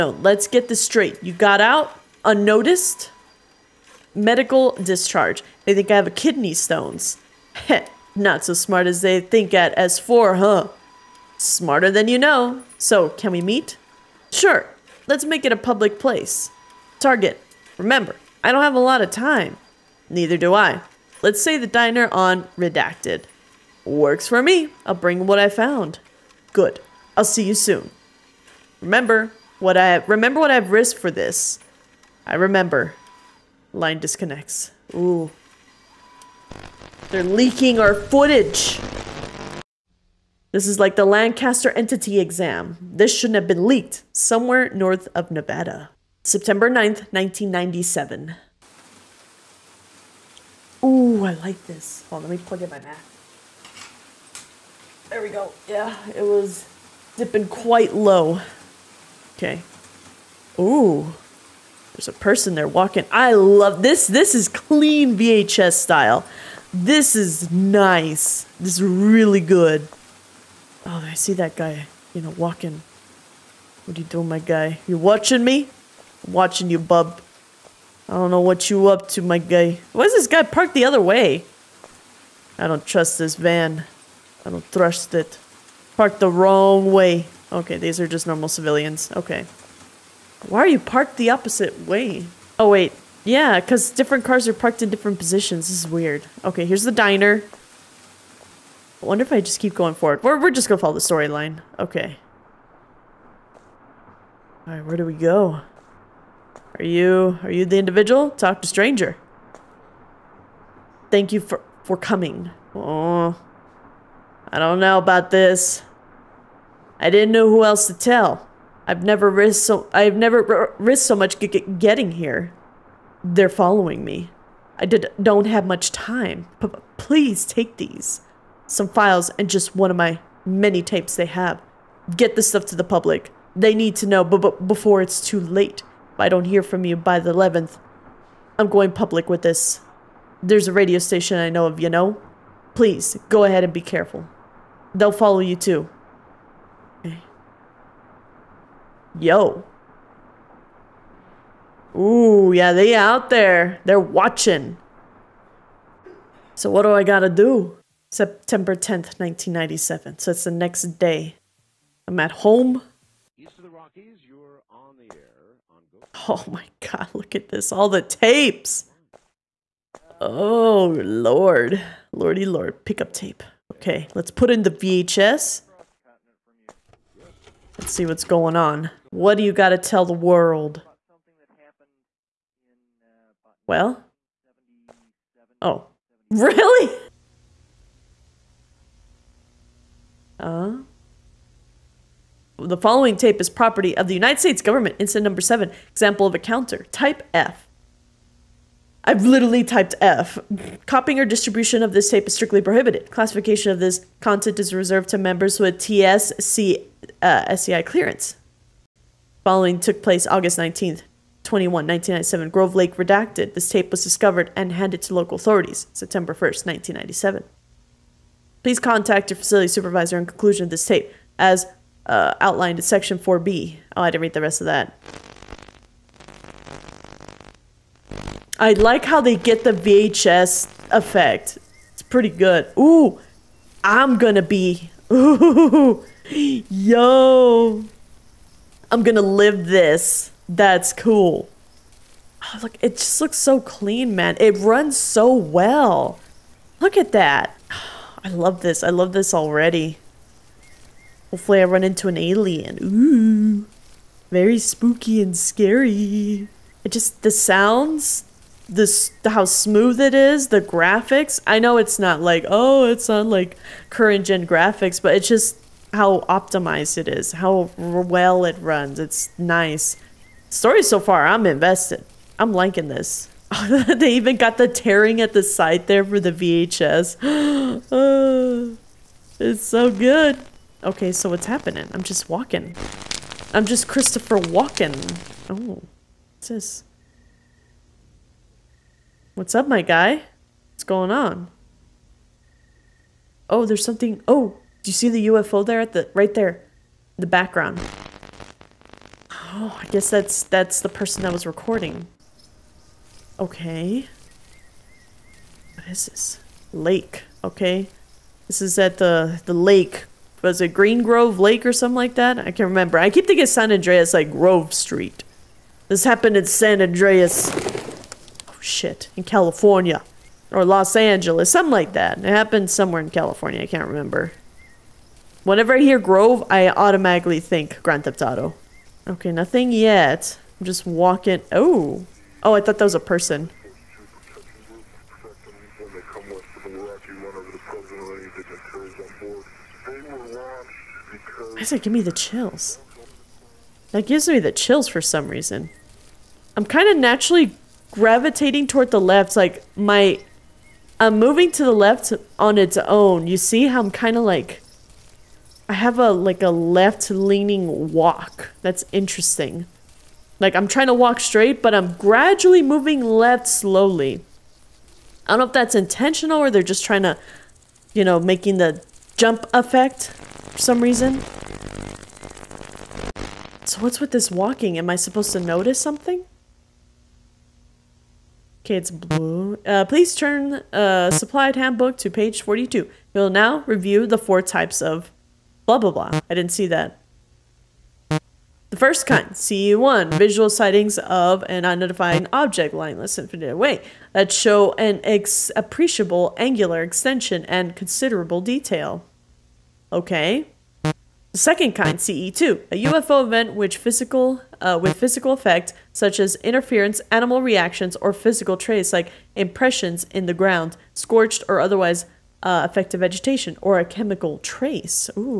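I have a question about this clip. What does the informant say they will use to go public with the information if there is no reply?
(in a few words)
a radio station.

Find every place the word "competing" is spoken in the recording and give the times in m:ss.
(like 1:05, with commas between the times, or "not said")
not said.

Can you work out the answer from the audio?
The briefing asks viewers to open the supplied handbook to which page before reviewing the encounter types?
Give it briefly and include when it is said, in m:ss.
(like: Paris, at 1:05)
42, at 6:22.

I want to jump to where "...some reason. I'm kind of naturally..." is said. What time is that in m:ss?
5:44.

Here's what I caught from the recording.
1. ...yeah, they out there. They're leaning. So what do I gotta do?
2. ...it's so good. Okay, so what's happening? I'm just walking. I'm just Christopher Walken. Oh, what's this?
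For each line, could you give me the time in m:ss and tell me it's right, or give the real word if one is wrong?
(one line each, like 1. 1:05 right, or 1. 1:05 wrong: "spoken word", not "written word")
1. 2:32 wrong: "watching", not "leaning"
2. 4:39 right.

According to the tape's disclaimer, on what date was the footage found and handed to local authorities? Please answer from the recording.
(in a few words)
September 1st, 1997.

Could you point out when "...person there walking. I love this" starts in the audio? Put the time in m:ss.
1:02.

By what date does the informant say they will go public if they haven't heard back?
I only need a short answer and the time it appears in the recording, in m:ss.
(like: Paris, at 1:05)
the 11th, at 2:17.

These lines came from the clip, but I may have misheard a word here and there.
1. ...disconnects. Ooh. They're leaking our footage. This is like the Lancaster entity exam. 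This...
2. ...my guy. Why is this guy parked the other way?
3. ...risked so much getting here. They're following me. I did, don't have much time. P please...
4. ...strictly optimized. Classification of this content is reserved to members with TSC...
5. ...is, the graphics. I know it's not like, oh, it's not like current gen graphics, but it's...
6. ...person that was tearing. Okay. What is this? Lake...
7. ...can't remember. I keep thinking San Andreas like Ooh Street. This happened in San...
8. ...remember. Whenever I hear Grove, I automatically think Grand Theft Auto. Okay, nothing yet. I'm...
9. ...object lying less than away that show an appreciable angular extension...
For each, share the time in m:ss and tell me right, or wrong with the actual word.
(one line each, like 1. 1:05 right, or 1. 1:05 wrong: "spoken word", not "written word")
1. 0:33 right
2. 1:19 right
3. 2:00 right
4. 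3:22 wrong: "prohibited", not "optimized"
5. 4:20 right
6. 5:00 wrong: "recording", not "tearing"
7. 5:12 wrong: "Grove", not "Ooh"
8. 5:23 right
9. 6:32 right.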